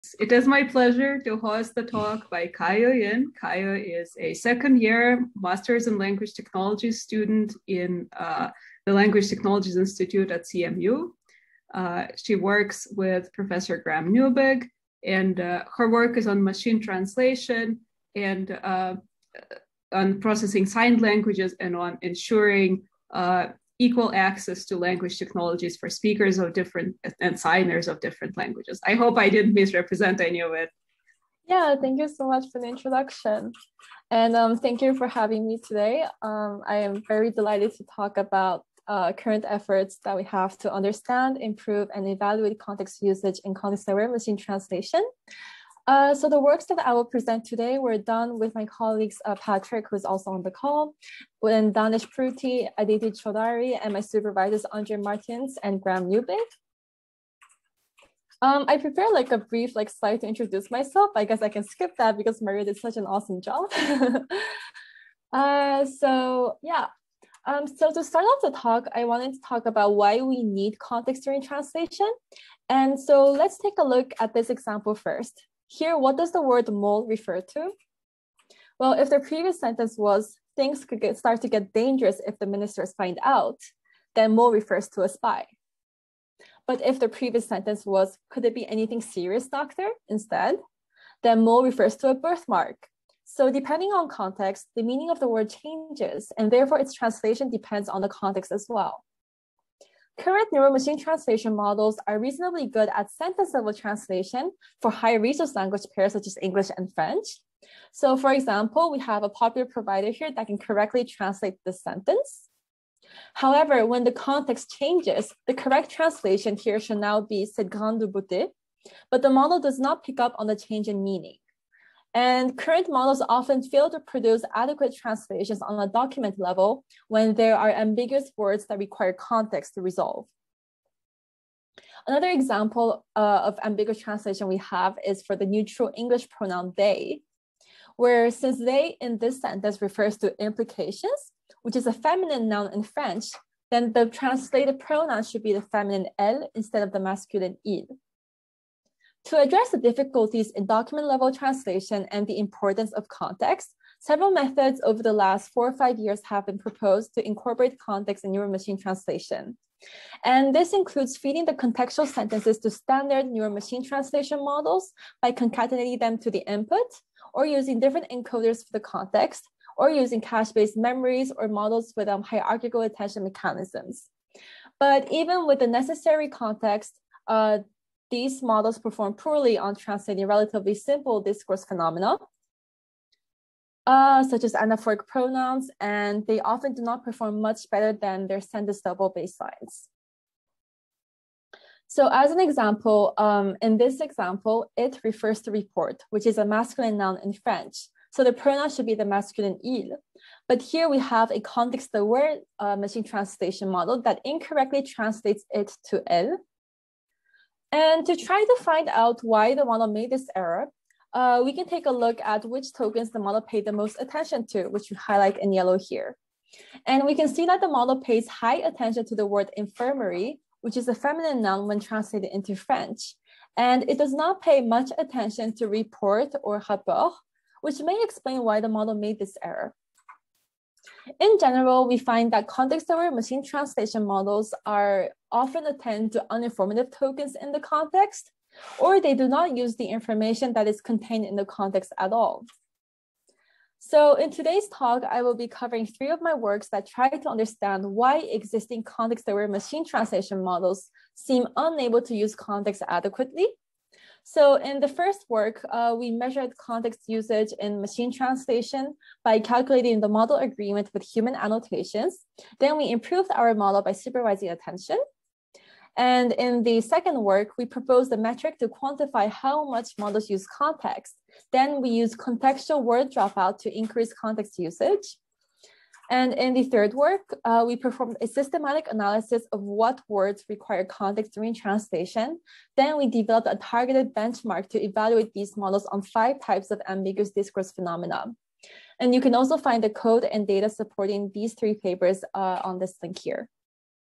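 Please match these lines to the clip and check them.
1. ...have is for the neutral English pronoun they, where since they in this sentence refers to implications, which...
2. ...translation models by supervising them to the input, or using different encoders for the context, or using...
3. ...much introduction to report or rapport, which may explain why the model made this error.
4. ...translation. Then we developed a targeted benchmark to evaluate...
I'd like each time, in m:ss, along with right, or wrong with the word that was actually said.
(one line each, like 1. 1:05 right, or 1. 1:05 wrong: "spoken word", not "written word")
1. 2:14 right
2. 2:43 wrong: "concatenating", not "supervising"
3. 3:44 wrong: "attention", not "introduction"
4. 4:41 right.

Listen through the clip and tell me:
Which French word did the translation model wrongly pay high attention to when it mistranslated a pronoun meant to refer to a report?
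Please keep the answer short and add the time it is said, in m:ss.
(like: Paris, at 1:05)
infirmary, at 3:39.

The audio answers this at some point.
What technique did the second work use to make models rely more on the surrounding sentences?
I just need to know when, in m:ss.
4:32.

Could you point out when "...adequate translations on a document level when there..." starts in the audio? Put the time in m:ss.
2:04.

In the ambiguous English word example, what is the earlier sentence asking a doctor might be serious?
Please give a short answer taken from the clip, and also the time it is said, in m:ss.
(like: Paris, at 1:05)
a birthmark, at 1:32.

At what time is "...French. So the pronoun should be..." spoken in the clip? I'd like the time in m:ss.
3:17.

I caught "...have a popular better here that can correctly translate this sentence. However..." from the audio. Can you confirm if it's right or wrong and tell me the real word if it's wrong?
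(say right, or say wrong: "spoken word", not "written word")
wrong: "provider", not "better".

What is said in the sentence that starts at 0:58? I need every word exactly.
Um, I prepared like a brief like slide to introduce myself.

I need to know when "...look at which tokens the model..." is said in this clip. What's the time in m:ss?
3:31.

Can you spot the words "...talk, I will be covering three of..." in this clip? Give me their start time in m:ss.
4:04.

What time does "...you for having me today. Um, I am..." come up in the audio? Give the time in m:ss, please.
0:34.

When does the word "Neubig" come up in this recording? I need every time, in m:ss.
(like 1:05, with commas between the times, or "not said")
0:14, 0:56.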